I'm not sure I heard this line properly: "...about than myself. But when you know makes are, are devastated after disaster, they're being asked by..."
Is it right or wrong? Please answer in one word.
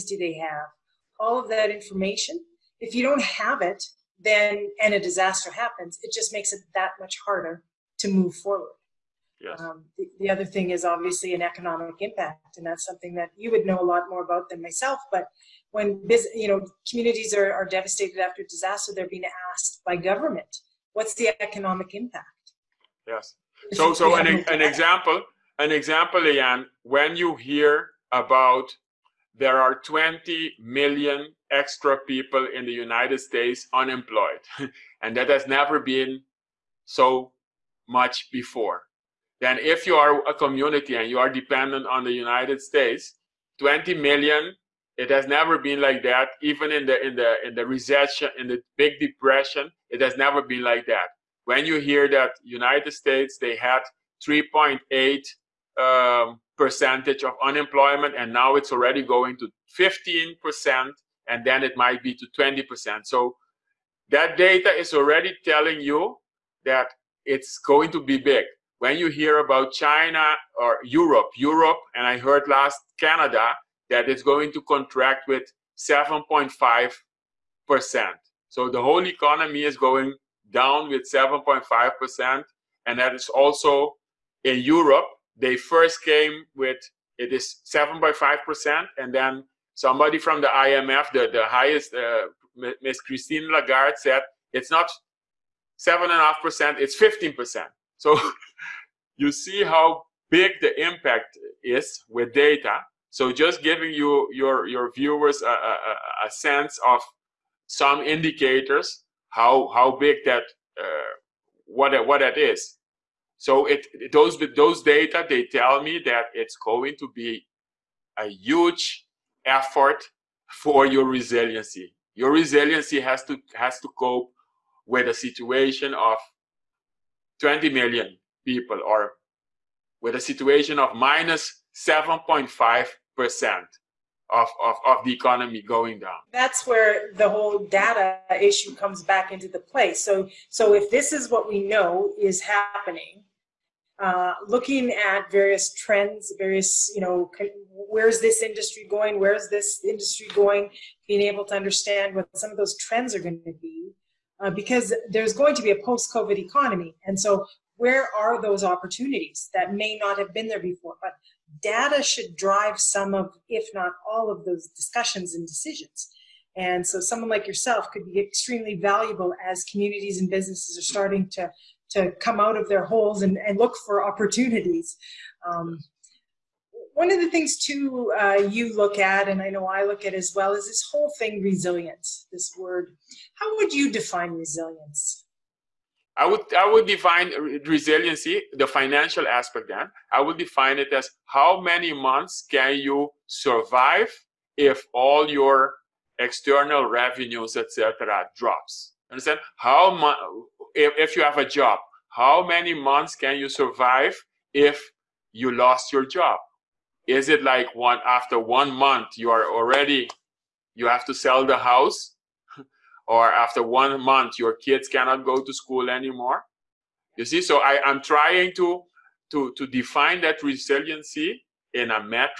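wrong.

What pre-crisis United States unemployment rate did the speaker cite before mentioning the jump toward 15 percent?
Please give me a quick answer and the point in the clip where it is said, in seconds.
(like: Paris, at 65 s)
3.8 percent, at 54 s.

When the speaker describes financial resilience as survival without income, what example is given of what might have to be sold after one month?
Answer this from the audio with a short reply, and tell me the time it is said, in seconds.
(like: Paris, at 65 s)
the house, at 211 s.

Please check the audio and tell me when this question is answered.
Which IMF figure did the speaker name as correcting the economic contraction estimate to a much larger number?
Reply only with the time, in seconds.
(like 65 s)
93 s.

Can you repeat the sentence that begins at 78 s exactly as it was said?
So the whole economy is going down with 7.5 percent, and that is also in Europe.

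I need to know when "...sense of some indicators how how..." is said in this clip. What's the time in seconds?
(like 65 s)
106 s.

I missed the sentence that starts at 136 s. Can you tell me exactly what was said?
That's where the whole data issue comes back into the play.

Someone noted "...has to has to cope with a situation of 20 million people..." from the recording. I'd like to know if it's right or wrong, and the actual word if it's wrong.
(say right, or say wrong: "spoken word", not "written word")
right.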